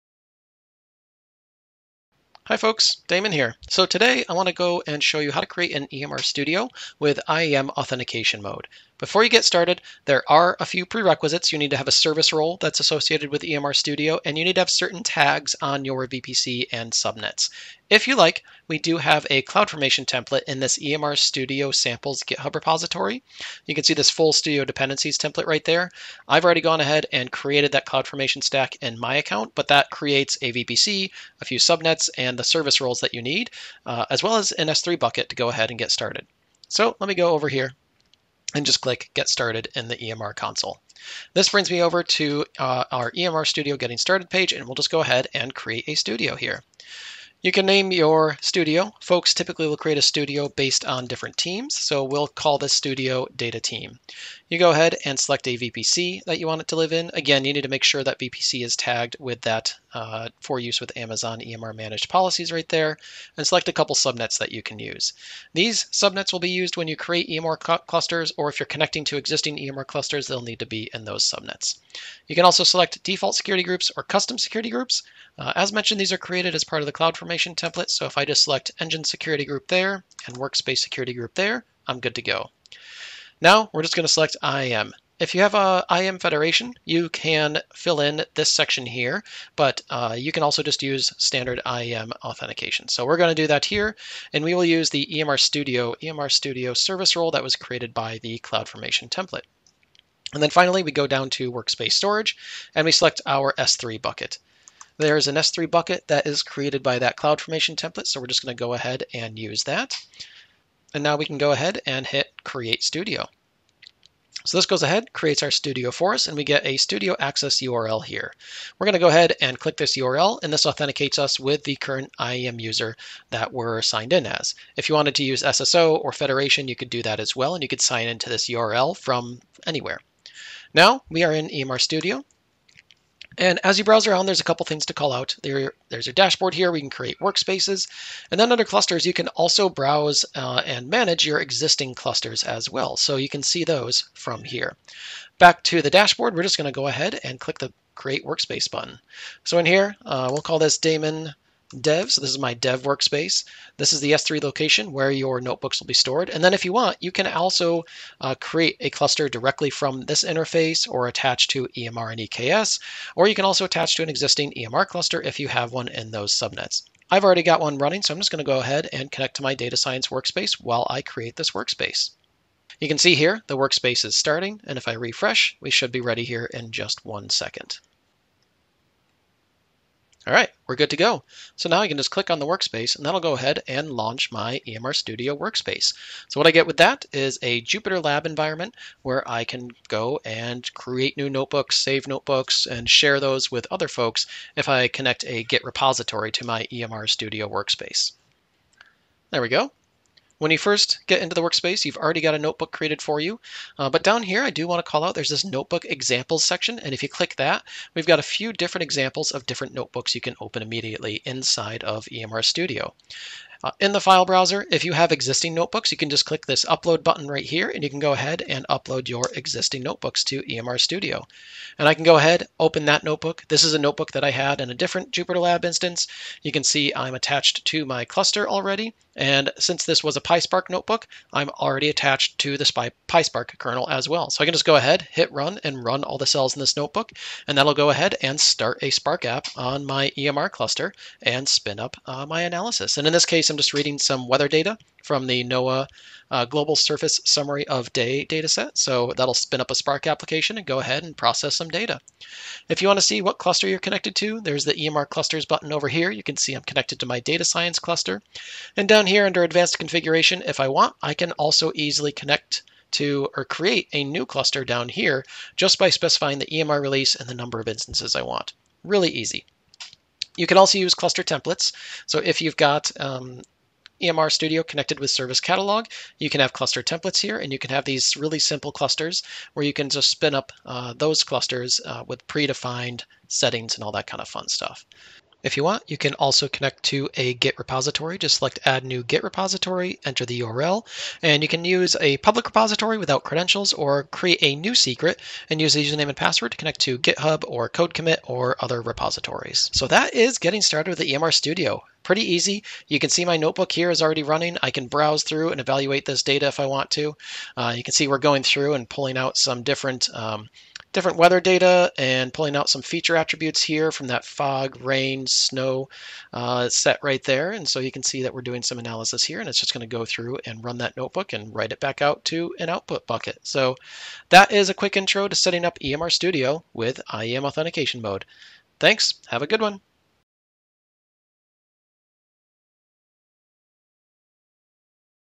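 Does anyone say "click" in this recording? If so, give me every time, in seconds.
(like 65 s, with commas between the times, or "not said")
38 s, 119 s, 147 s, 182 s, 207 s, 216 s.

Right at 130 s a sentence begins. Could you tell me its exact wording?
Now we are in EMR Studio, and as you browse around, there's a couple things to call out.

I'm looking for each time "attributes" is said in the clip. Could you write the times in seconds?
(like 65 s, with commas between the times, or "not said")
313 s.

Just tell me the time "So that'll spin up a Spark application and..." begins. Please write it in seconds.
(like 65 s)
248 s.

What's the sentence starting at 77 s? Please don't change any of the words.
So if I just select engine security group there and workspace security group there, I'm good to go.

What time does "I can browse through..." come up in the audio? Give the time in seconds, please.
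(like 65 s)
304 s.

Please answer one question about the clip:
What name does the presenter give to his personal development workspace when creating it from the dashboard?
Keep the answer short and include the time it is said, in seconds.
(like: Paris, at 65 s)
Damon dev, at 150 s.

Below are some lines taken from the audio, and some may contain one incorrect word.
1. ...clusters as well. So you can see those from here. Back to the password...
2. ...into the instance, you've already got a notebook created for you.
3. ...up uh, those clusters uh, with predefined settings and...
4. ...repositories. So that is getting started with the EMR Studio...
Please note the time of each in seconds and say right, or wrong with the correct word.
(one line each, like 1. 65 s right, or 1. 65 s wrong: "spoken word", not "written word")
1. 141 s wrong: "dashboard", not "password"
2. 201 s wrong: "workspace", not "instance"
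3. 280 s right
4. 298 s right.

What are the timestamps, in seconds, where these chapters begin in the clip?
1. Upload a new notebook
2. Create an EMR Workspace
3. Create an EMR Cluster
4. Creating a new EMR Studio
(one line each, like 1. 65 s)
1. 213 s
2. 149 s
3. 254 s
4. 41 s.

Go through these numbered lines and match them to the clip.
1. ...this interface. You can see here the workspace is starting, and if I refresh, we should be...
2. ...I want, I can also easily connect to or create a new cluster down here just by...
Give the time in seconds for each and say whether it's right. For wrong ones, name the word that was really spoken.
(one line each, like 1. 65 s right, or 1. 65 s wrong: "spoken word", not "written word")
1. 171 s wrong: "workspace", not "interface"
2. 260 s right.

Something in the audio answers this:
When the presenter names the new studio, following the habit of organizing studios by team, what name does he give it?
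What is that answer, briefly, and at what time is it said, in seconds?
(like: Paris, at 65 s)
data team, at 53 s.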